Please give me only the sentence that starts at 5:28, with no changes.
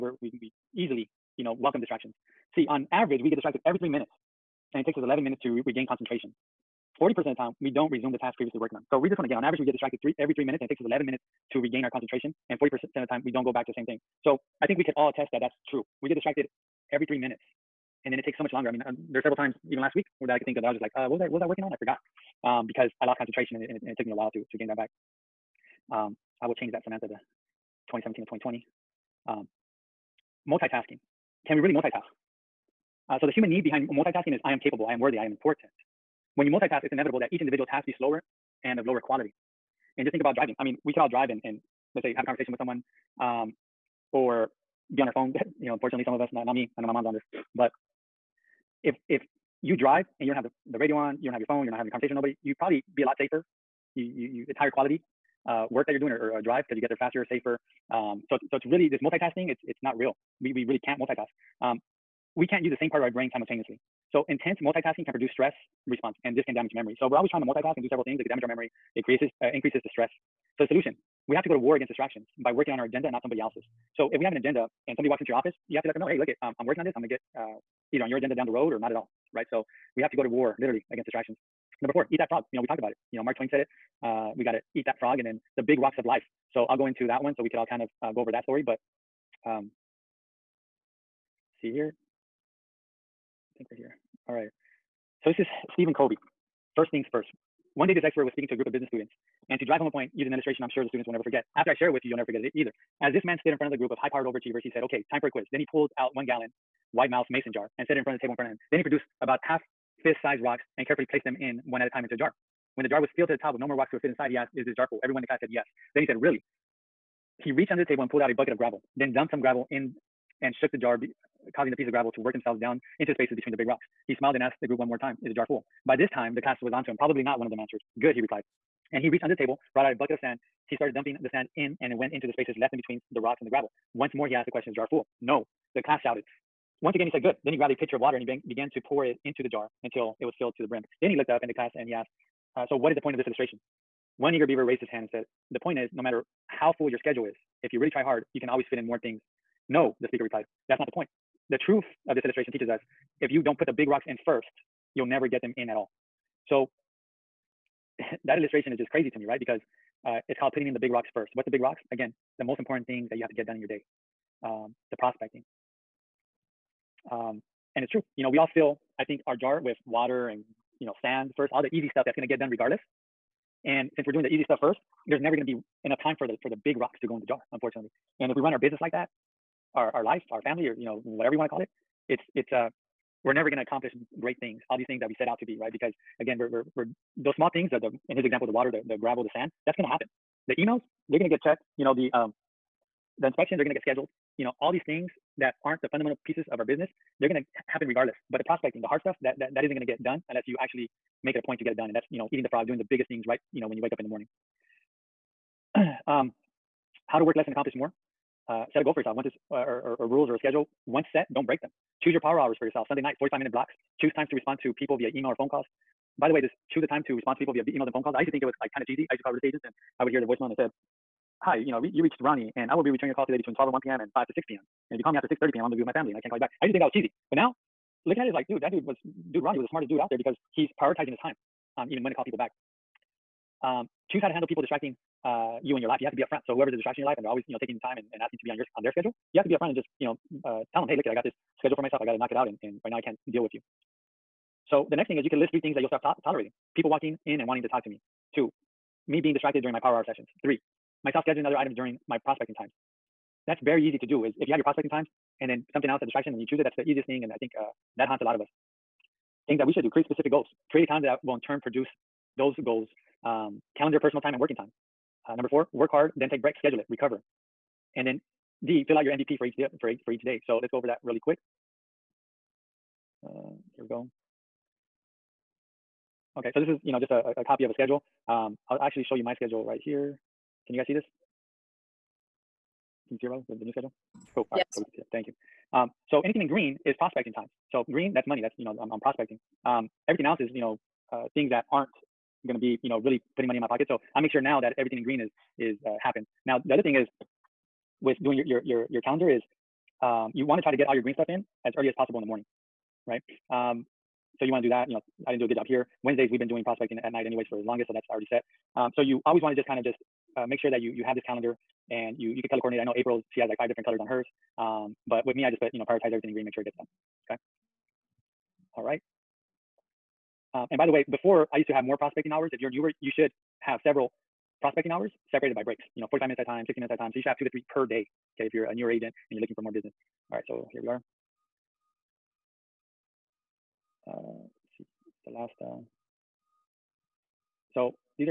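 Okay, if you're a newer agent and you're looking for more business.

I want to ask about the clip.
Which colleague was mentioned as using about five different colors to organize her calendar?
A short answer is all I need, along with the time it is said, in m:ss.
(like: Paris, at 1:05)
April, at 5:12.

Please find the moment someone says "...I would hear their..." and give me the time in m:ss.
3:40.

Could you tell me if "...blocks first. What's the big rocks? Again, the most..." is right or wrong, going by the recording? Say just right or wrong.
wrong.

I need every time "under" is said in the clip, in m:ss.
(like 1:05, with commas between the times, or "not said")
1:57, 2:09.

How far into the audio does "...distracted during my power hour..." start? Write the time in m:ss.
4:09.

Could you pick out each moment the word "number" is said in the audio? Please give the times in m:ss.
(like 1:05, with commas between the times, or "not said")
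1:21, 4:25.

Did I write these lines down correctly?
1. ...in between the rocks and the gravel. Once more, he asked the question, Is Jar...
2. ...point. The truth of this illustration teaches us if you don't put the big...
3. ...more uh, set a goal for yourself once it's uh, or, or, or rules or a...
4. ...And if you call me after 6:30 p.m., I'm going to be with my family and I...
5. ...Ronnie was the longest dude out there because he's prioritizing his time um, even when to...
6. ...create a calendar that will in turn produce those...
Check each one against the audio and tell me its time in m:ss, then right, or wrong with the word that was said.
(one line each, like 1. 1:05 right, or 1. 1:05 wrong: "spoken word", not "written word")
1. 2:12 right
2. 2:30 right
3. 3:27 right
4. 3:44 right
5. 3:49 wrong: "smartest", not "longest"
6. 4:20 right.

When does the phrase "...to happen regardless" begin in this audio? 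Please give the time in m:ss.
3:17.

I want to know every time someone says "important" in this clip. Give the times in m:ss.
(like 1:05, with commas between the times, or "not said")
0:35, 2:42.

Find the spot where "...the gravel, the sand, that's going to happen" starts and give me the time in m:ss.
3:08.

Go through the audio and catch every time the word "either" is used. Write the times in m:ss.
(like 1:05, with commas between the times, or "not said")
1:17, 1:42.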